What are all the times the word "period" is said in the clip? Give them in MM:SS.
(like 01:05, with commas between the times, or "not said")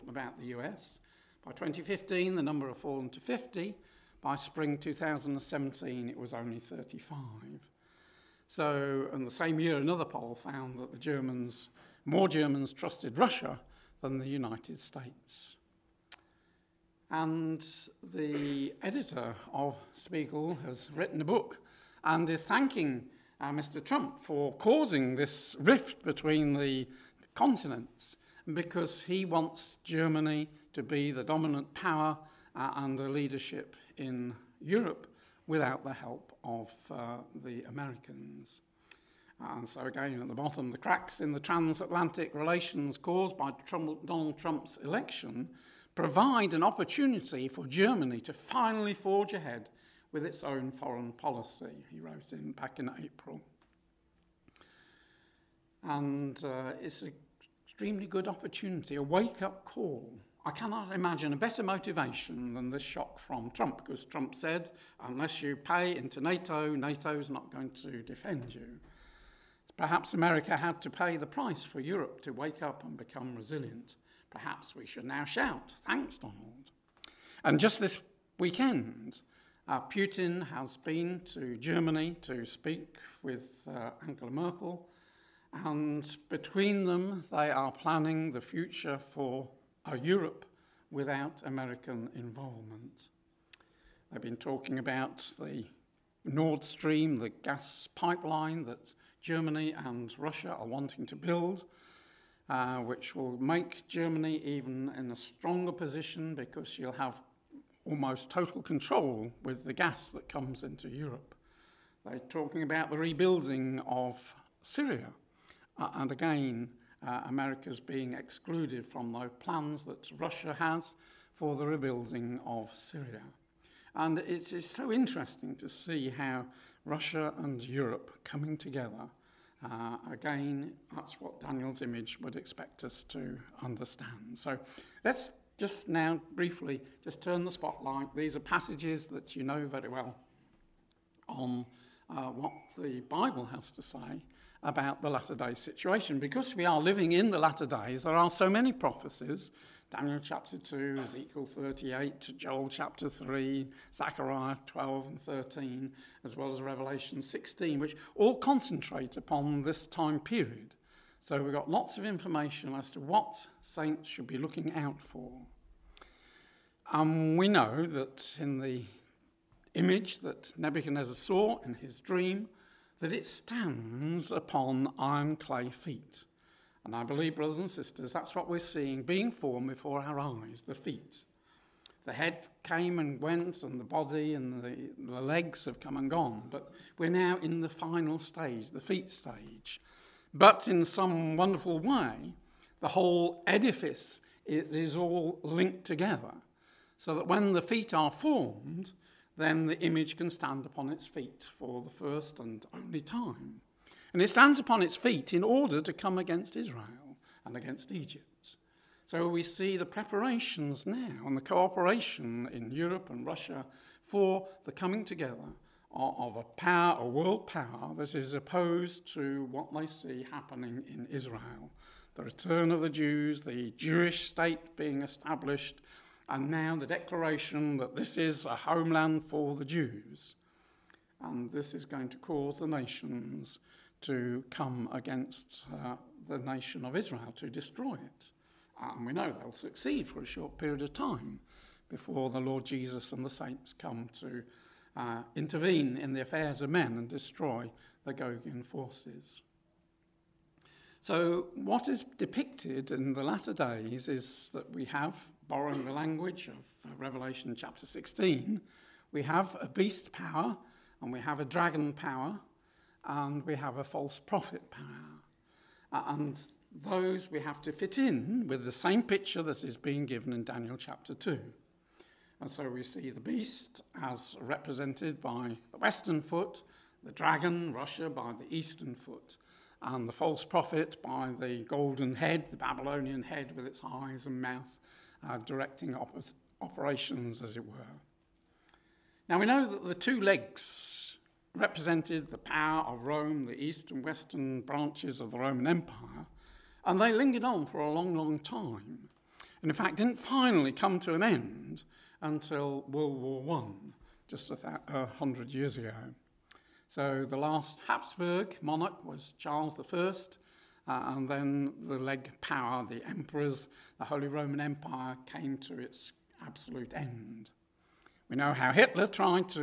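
02:40, 04:00.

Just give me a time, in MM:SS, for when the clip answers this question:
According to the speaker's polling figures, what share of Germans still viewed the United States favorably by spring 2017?
00:06.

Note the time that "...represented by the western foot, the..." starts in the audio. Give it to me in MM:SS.
04:34.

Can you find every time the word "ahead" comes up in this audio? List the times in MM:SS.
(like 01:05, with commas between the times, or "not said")
00:49.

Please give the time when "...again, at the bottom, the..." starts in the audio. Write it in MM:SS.
00:39.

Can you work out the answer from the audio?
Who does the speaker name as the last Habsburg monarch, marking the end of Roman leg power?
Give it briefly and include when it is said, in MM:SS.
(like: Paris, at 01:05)
Charles I, at 05:09.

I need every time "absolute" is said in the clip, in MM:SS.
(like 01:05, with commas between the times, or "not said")
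05:16.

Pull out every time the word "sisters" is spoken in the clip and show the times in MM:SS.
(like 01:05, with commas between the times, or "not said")
02:57.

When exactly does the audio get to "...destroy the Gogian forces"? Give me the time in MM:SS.
04:07.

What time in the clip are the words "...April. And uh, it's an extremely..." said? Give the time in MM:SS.
00:53.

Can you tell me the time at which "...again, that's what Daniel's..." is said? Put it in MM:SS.
02:10.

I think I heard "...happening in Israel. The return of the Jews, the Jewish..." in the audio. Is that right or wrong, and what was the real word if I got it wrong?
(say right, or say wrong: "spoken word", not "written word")
right.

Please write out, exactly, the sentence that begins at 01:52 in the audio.
They're talking about the rebuilding of Syria.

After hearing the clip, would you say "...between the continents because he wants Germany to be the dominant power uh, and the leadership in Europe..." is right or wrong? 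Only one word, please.
right.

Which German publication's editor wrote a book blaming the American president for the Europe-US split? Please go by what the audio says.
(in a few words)
Spiegel.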